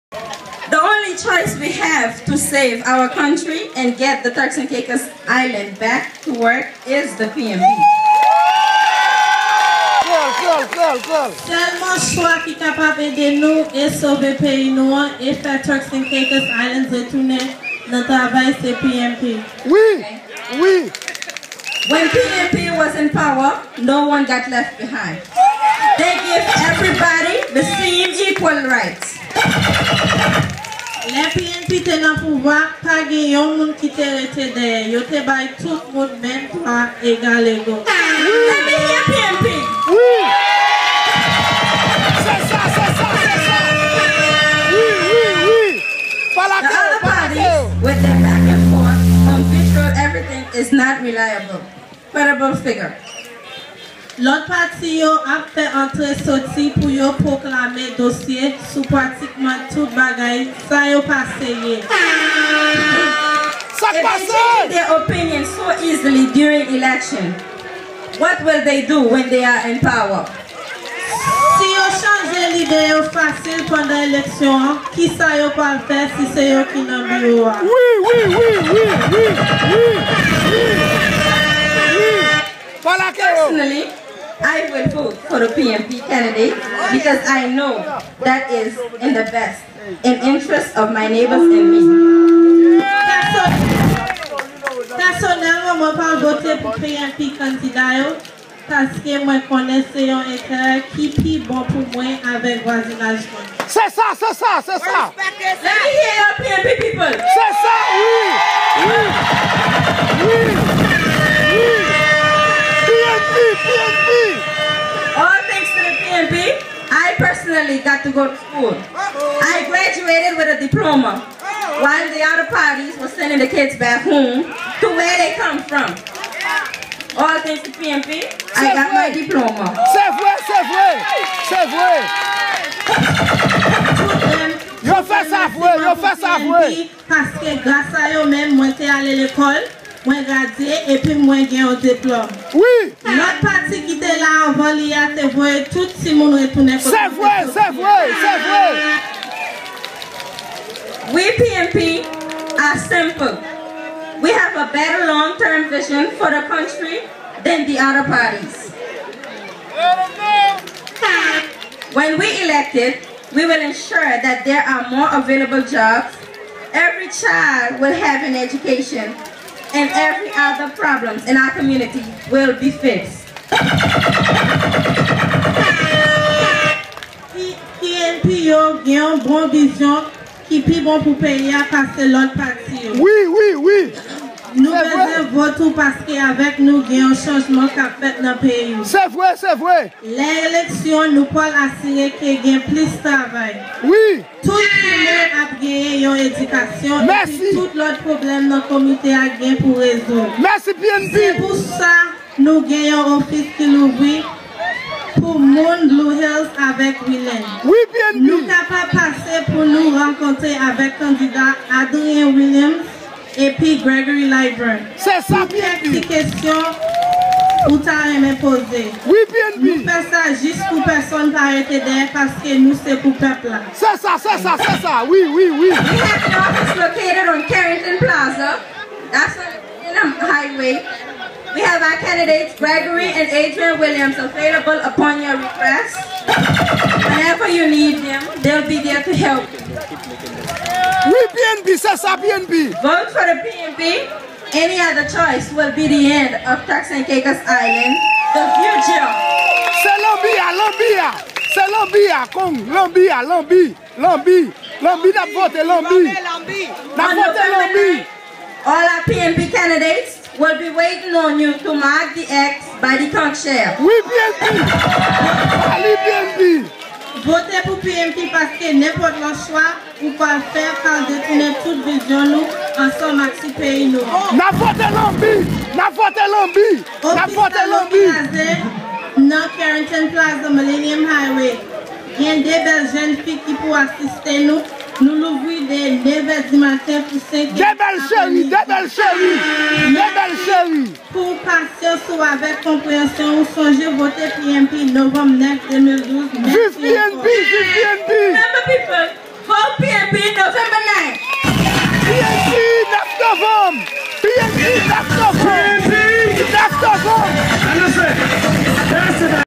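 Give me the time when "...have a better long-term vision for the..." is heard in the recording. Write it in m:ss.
2:34.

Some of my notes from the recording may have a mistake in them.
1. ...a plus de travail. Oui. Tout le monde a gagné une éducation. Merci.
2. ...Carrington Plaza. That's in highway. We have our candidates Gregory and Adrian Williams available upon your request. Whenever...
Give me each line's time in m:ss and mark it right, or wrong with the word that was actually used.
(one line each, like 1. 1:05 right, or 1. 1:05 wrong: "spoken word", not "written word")
1. 3:12 right
2. 3:47 right.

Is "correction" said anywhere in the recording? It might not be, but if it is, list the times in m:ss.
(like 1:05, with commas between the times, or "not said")
not said.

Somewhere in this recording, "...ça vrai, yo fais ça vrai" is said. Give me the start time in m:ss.
2:15.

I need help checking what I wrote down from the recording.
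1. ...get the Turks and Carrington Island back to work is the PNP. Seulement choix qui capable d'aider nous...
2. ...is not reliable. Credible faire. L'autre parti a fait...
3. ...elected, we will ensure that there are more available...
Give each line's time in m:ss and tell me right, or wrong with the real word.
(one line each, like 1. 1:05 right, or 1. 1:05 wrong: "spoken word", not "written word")
1. 0:03 wrong: "Caicos", not "Carrington"
2. 0:50 wrong: "figure", not "faire"
3. 2:42 right.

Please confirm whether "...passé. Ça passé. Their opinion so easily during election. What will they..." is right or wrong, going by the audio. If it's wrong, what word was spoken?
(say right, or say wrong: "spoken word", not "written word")
right.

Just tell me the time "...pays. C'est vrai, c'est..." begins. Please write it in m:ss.
3:08.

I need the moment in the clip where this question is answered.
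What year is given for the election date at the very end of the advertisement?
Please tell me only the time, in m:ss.
4:55.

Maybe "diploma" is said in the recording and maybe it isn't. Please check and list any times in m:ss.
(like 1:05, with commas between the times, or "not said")
2:00, 2:09.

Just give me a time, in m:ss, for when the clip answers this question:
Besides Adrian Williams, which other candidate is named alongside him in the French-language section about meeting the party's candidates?
3:33.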